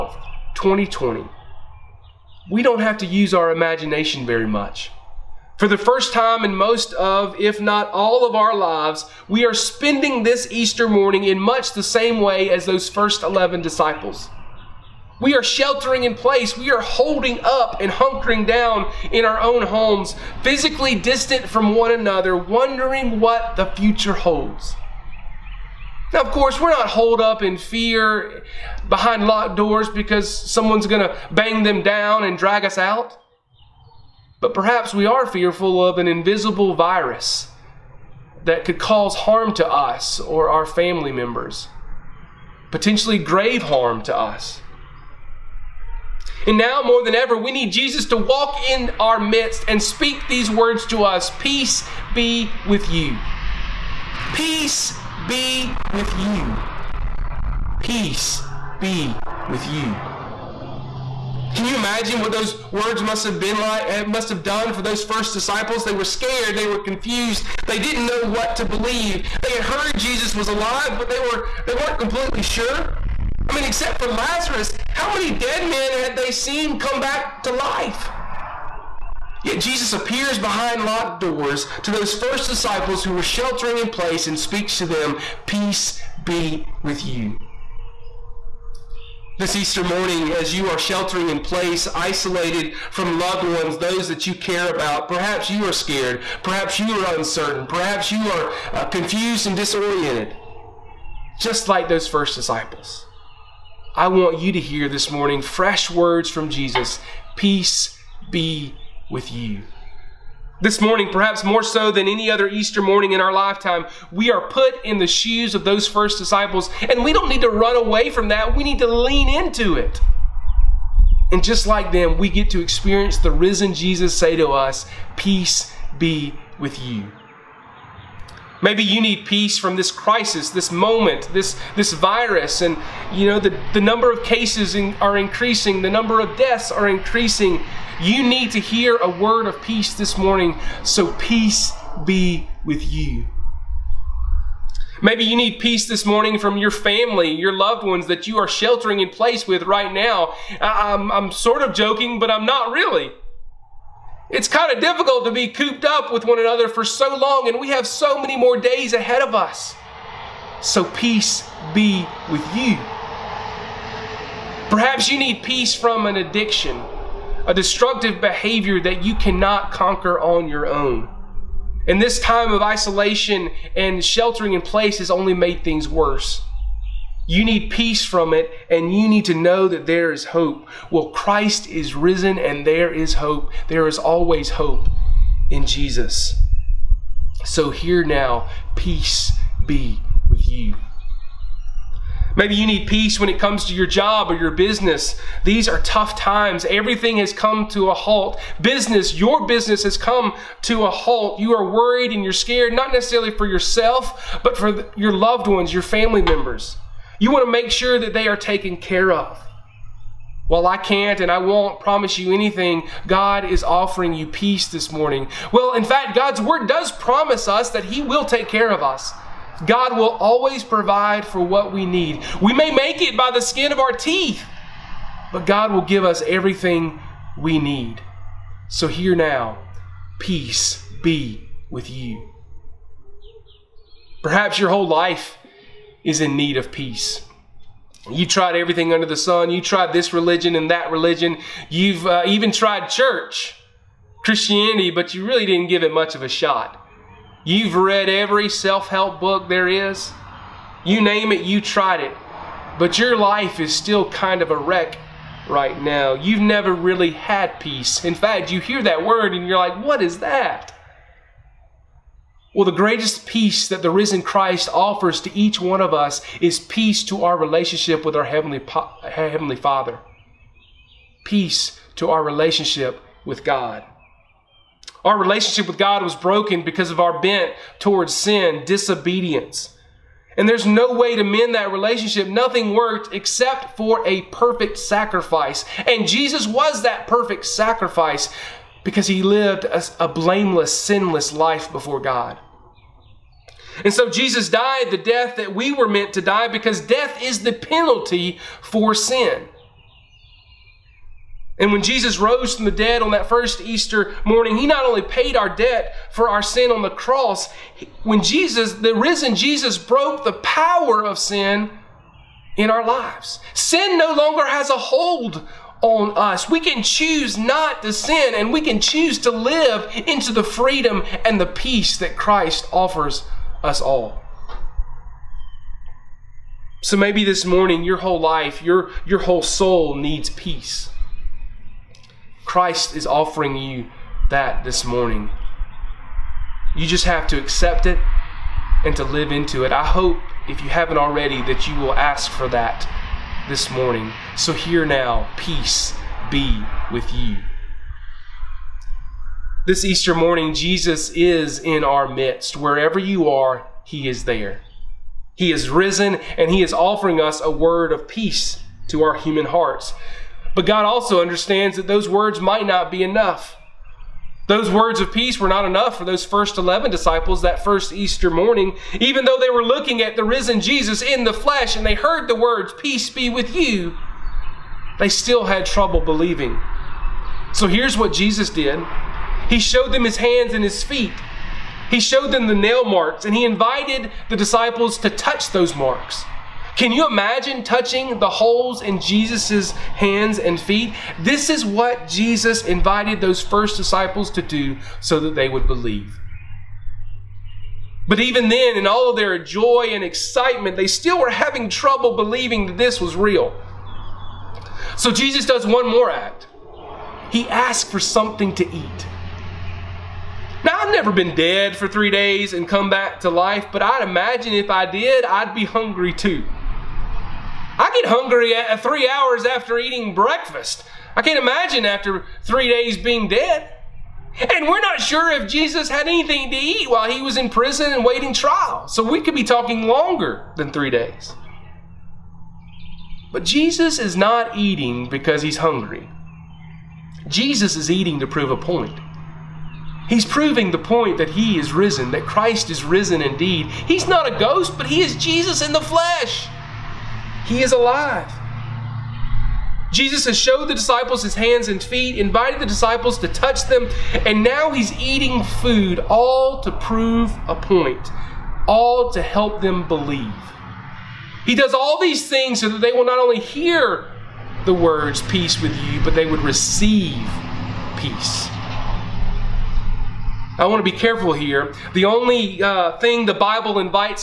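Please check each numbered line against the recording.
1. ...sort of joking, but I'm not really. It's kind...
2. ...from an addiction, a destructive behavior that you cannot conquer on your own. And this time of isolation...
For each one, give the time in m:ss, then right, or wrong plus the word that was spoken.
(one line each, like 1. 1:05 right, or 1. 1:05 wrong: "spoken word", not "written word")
1. 2:31 right
2. 2:45 right.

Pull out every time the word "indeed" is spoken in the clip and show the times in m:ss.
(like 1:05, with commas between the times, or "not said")
7:23.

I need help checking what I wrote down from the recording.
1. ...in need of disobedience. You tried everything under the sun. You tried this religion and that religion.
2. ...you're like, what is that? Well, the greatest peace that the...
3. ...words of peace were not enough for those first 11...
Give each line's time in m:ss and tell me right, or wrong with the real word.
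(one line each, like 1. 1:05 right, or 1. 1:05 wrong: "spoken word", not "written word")
1. 3:56 wrong: "peace", not "disobedience"
2. 4:19 right
3. 6:04 right.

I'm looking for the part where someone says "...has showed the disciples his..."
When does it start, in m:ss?
7:30.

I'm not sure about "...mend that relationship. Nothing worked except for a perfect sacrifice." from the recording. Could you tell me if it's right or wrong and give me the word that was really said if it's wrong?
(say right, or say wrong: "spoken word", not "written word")
right.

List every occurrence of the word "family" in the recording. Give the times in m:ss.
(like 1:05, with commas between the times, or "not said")
0:40, 2:26, 3:25.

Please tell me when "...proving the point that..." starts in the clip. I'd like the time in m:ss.
7:20.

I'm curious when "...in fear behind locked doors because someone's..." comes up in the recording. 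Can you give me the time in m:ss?
0:27.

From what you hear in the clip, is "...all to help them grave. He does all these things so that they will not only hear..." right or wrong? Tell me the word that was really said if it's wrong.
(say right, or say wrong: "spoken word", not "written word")
wrong: "believe", not "grave".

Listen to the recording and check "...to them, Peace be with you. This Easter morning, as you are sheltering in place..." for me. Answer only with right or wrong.
right.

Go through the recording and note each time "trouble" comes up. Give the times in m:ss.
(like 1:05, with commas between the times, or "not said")
6:15, 6:41.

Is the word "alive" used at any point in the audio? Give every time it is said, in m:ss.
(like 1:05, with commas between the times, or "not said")
1:10, 7:27.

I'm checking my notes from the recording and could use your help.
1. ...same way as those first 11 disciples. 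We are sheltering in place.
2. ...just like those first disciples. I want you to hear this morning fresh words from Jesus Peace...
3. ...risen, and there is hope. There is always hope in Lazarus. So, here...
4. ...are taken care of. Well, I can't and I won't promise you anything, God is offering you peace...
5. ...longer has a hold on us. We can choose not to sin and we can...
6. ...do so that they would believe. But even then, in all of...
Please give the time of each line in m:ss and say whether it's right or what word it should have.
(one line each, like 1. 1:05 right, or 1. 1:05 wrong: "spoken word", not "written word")
1. 0:11 right
2. 1:41 right
3. 3:01 wrong: "Jesus", not "Lazarus"
4. 3:28 right
5. 5:14 right
6. 6:34 right.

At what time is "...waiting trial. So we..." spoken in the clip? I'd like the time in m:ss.
7:08.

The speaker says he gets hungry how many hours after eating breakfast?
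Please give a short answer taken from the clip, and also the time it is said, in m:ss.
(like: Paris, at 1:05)
3, at 6:58.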